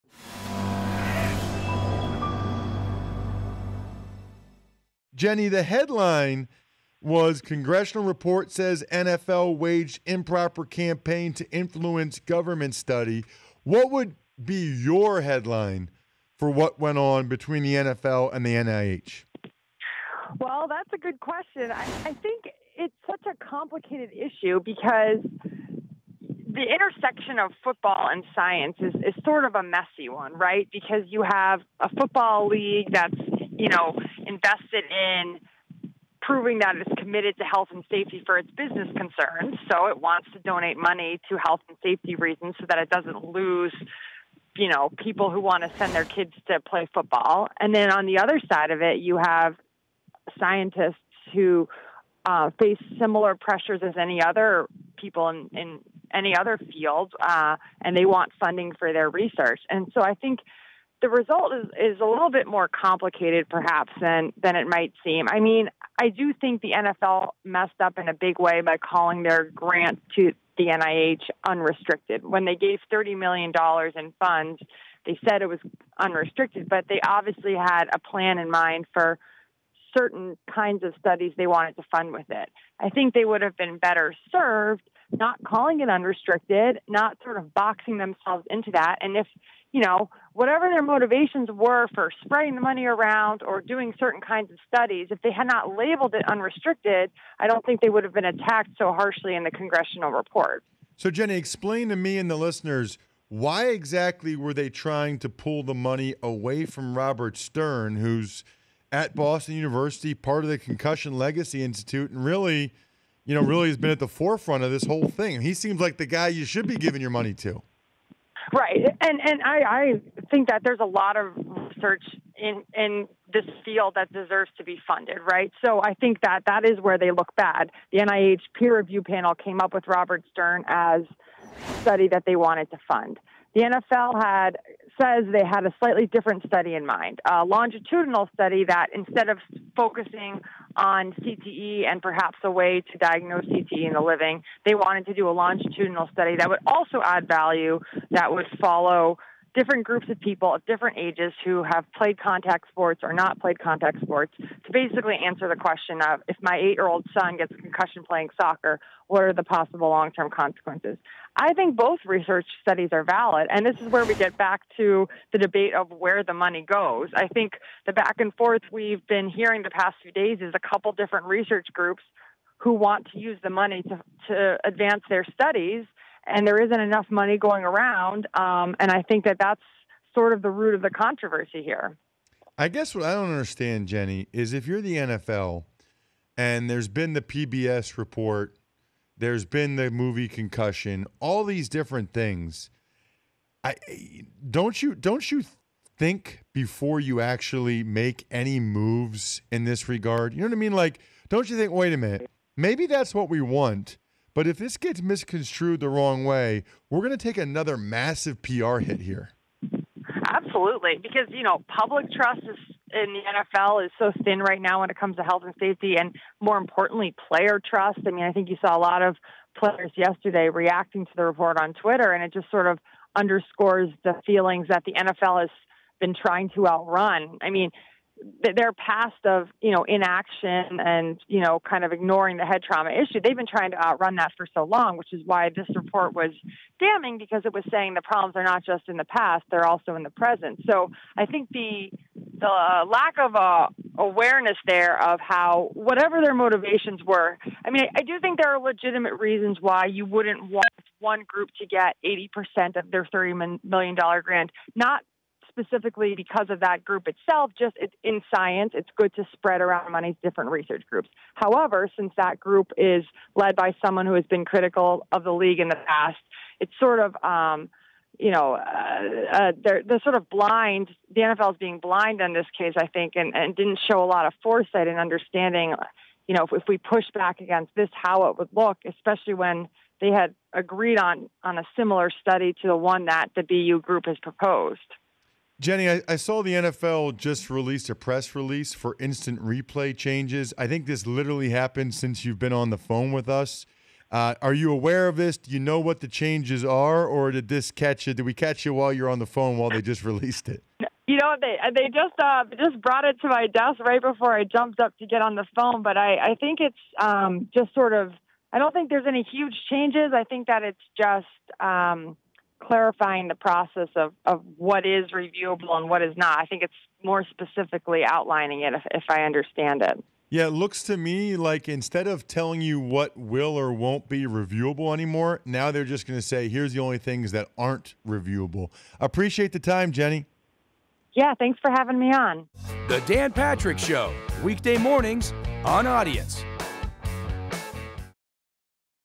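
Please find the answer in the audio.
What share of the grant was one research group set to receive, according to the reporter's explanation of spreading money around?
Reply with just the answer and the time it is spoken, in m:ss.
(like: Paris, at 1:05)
80%, at 4:12.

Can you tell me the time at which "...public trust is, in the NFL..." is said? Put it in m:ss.
3:31.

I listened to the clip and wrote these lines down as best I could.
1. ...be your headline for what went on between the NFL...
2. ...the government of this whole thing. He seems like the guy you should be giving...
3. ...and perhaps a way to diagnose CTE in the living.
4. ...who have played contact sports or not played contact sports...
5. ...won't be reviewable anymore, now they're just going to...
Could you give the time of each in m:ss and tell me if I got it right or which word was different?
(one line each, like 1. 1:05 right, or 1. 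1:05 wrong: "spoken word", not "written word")
1. 0:14 right
2. 1:53 wrong: "forefront", not "government"
3. 2:21 right
4. 2:31 right
5. 5:23 right.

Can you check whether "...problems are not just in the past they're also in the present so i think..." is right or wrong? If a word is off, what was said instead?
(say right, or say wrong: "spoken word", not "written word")
right.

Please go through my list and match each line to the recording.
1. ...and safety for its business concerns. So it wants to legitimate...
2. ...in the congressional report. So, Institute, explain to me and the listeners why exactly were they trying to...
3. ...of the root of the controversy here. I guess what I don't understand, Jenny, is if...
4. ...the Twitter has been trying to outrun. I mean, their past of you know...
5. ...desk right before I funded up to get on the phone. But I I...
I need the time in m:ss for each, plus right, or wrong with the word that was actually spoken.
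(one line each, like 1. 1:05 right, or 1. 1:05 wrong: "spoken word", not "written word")
1. 0:37 wrong: "donate", not "legitimate"
2. 1:39 wrong: "Jenny", not "Institute"
3. 3:00 right
4. 3:44 wrong: "NFL", not "Twitter"
5. 5:03 wrong: "jumped", not "funded".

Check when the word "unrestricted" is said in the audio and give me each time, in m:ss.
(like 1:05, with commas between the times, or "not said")
1:11, 1:15, 1:25, 1:36.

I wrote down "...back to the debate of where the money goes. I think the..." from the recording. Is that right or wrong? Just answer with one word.
right.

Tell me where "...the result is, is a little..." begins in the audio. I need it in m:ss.
1:01.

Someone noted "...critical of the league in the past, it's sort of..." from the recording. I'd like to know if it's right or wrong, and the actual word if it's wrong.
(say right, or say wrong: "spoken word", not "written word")
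right.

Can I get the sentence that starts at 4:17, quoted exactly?
Just in science, it's good to spread around money to different research groups.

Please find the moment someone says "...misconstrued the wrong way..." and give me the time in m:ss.
3:25.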